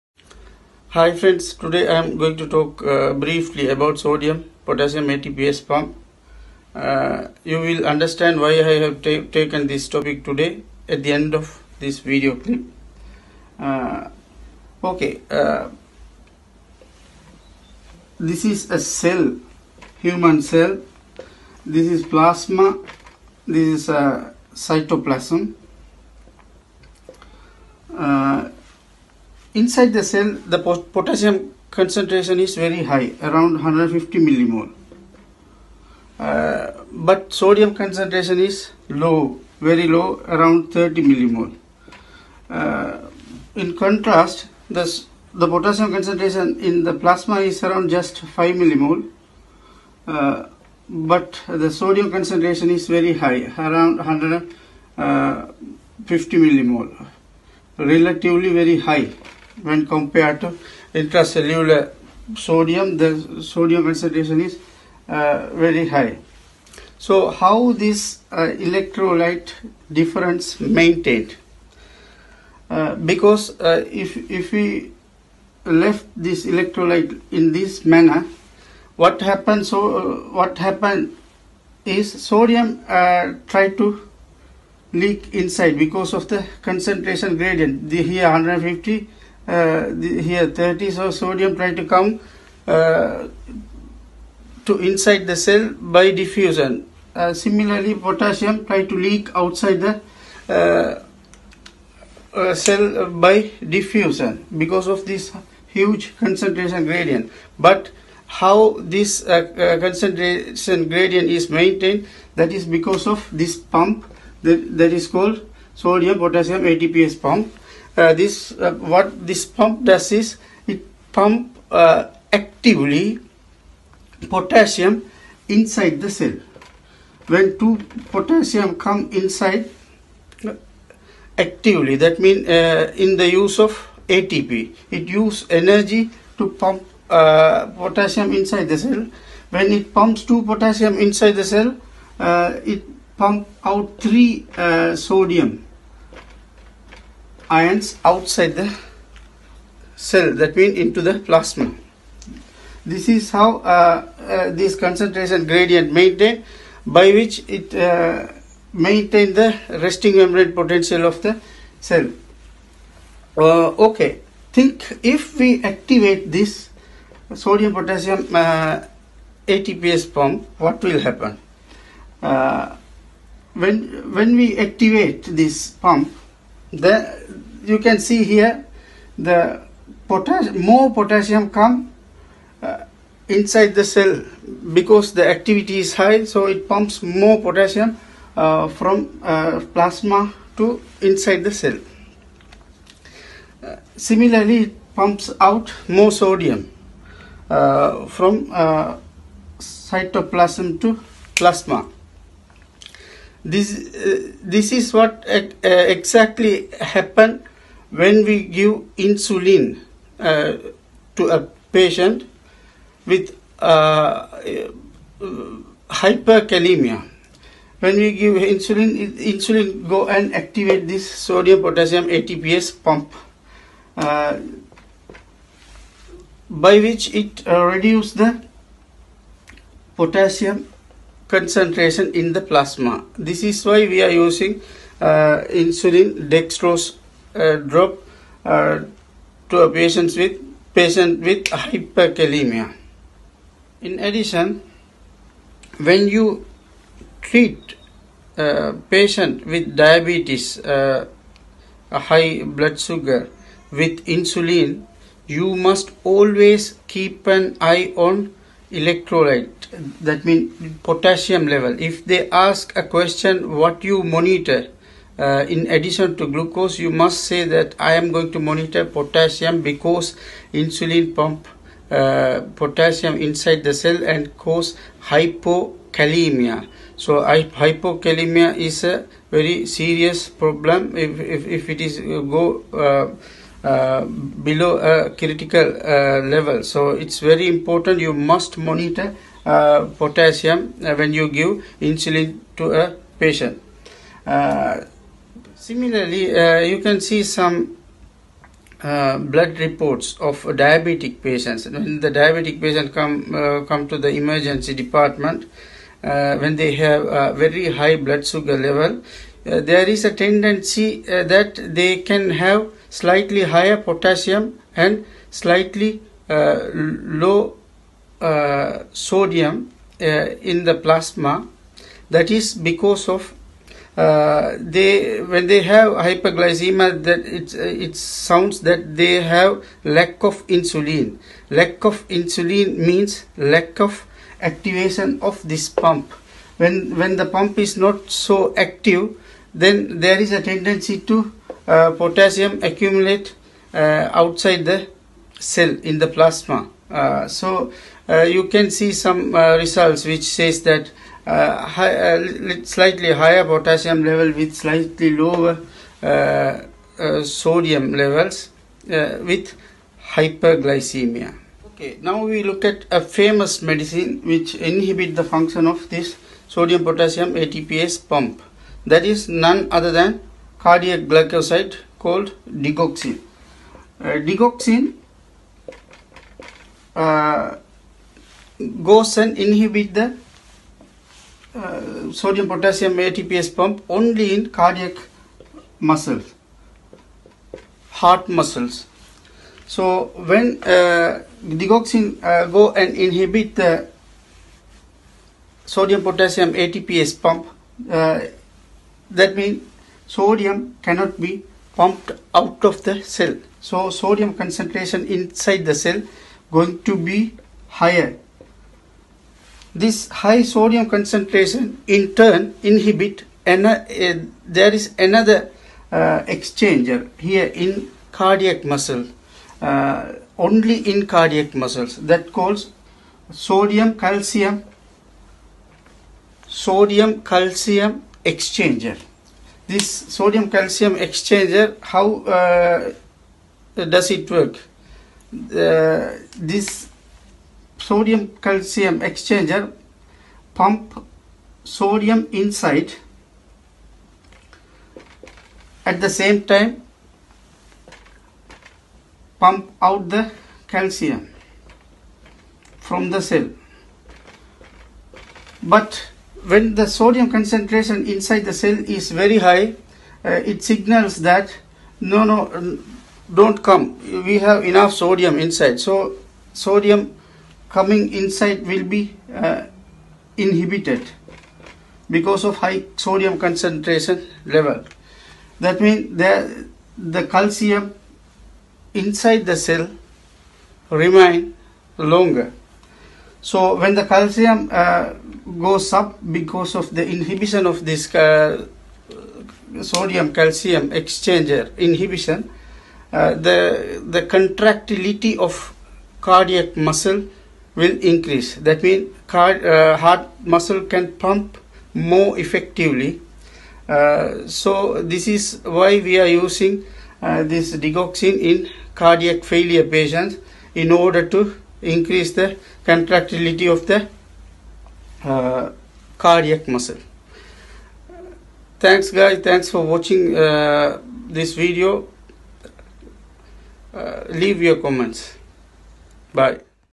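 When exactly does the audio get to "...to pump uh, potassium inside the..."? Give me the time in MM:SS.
02:16.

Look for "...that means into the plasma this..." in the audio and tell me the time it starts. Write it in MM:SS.
02:30.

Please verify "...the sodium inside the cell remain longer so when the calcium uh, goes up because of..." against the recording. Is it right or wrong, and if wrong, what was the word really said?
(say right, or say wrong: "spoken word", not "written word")
wrong: "calcium", not "sodium".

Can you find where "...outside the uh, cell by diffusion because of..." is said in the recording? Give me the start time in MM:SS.
01:39.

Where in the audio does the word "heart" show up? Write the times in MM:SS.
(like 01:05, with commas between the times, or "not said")
06:27, 08:19.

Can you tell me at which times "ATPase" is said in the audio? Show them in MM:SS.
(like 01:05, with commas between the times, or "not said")
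00:05, 01:56, 02:49, 03:42, 06:07, 06:22, 06:36.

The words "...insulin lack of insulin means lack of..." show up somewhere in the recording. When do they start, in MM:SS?
05:30.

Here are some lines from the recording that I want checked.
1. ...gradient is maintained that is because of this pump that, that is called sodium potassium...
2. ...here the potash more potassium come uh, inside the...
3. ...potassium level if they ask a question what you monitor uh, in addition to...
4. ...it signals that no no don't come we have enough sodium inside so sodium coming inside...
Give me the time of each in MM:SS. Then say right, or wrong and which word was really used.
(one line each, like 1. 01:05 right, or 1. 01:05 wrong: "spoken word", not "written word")
1. 01:50 right
2. 02:58 right
3. 04:20 right
4. 07:40 right.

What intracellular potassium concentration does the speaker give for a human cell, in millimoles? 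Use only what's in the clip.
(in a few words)
150.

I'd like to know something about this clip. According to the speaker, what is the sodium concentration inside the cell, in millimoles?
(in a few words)
30.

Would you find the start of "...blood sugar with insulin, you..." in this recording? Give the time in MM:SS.
04:12.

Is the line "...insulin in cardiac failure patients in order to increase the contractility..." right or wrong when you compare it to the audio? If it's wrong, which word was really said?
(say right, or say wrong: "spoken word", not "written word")
wrong: "digoxin", not "insulin".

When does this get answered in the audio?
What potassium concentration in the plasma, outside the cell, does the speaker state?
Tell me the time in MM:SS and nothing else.
00:47.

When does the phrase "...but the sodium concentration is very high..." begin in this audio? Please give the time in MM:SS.
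00:50.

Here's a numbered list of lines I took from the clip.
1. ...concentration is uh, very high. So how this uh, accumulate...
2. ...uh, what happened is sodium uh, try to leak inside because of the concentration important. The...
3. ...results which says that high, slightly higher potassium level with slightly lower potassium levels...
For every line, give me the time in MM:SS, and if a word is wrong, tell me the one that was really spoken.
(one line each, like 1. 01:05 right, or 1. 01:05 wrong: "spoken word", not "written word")
1. 01:03 wrong: "electrolyte", not "accumulate"
2. 01:19 wrong: "gradient", not "important"
3. 05:49 wrong: "sodium", not "potassium".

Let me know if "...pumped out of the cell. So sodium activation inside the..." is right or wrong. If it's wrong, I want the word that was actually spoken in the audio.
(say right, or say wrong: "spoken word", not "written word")
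wrong: "concentration", not "activation".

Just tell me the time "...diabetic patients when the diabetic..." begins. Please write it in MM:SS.
05:00.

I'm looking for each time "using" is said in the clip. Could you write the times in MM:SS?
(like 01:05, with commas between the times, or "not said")
03:54, 08:26.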